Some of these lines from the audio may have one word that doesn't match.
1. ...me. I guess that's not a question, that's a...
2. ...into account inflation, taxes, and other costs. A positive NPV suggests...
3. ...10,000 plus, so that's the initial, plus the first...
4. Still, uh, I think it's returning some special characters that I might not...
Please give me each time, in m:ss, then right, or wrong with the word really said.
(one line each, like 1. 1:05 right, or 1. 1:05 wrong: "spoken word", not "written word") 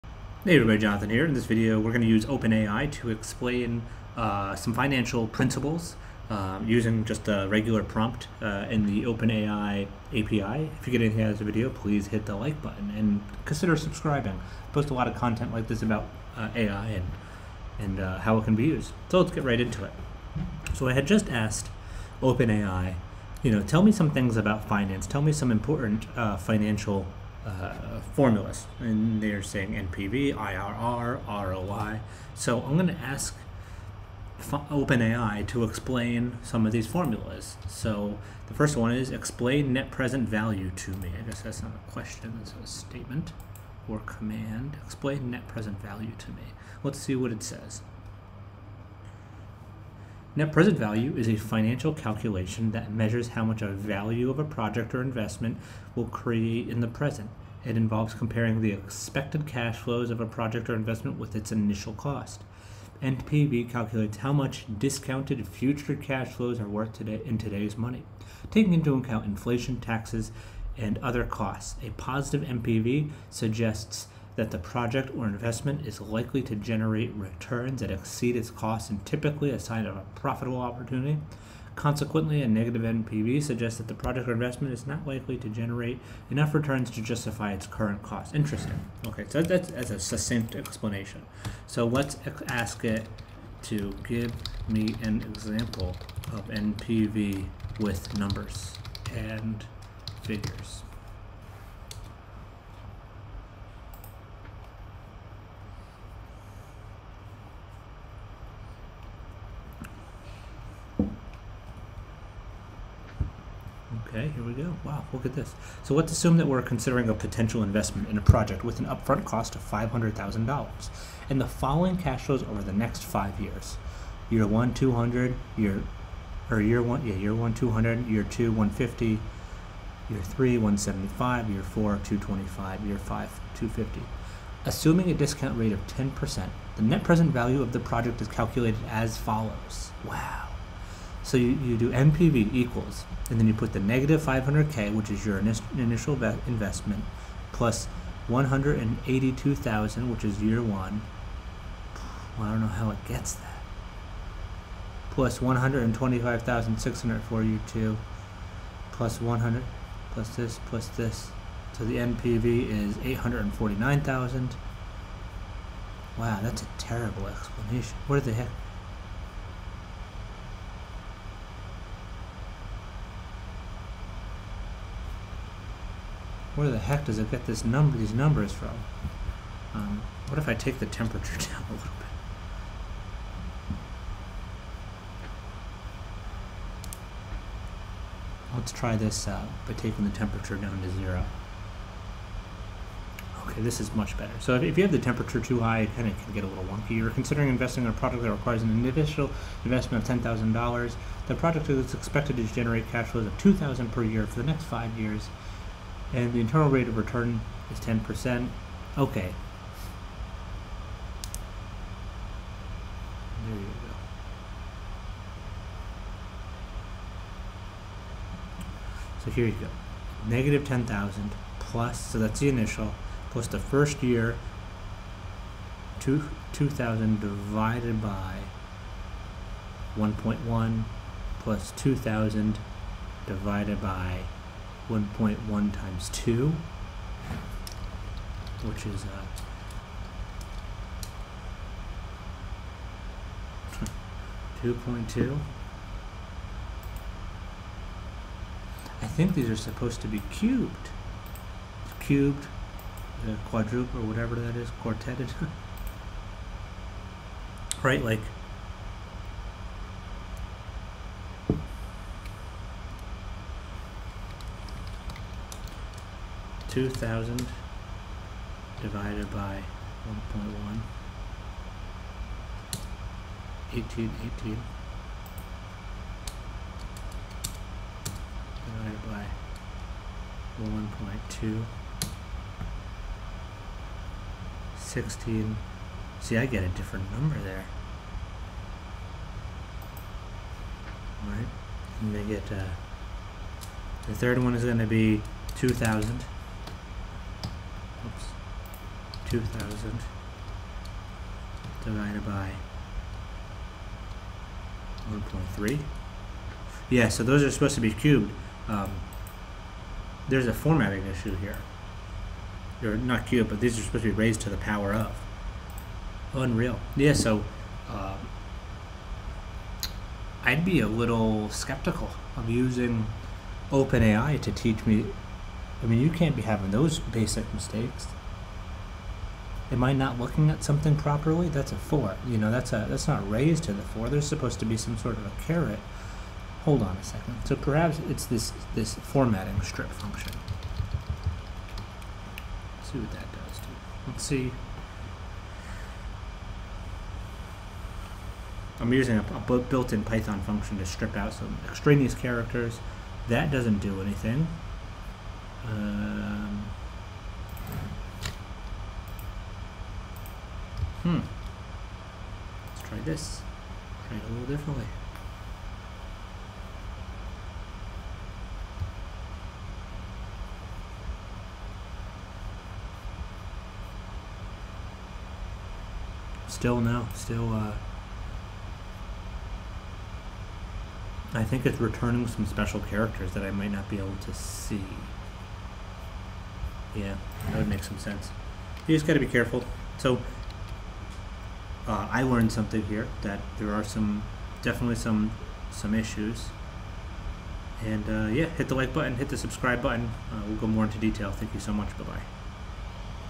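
1. 0:40 right
2. 1:08 right
3. 3:40 right
4. 6:17 right.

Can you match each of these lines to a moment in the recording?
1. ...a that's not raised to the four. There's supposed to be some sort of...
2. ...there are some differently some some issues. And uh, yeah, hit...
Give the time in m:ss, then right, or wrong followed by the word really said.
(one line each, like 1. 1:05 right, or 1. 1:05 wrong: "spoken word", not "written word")
1. 5:32 right
2. 6:33 wrong: "definitely", not "differently".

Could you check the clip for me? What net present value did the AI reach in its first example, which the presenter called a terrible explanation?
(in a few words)
849,000.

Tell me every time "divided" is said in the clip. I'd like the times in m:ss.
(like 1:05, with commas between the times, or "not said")
3:47, 3:53, 4:28, 4:38, 5:01.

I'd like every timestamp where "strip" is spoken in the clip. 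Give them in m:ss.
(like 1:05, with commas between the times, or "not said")
5:39, 5:50.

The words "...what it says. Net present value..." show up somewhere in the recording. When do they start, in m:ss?
0:47.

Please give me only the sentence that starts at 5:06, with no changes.
Yeah, so those are supposed to be cubed.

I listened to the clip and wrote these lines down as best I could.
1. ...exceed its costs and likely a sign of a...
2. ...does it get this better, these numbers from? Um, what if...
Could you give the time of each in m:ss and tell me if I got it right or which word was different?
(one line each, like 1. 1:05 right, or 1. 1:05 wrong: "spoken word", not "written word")
1. 1:17 wrong: "typically", not "likely"
2. 2:57 wrong: "number", not "better".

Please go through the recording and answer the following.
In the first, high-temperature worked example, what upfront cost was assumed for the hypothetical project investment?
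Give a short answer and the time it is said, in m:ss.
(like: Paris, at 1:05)
$500,000, at 1:59.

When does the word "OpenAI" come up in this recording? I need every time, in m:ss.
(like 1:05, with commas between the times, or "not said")
0:02, 0:09, 0:22, 0:34, 5:23.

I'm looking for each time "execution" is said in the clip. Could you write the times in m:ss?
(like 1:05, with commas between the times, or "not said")
not said.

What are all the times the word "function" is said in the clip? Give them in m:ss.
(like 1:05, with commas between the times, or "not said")
5:39, 5:50.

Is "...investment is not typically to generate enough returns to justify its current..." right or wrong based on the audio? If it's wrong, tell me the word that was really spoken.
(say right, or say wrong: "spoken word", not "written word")
wrong: "likely", not "typically".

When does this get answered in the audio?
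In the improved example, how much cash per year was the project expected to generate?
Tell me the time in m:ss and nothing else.
3:23.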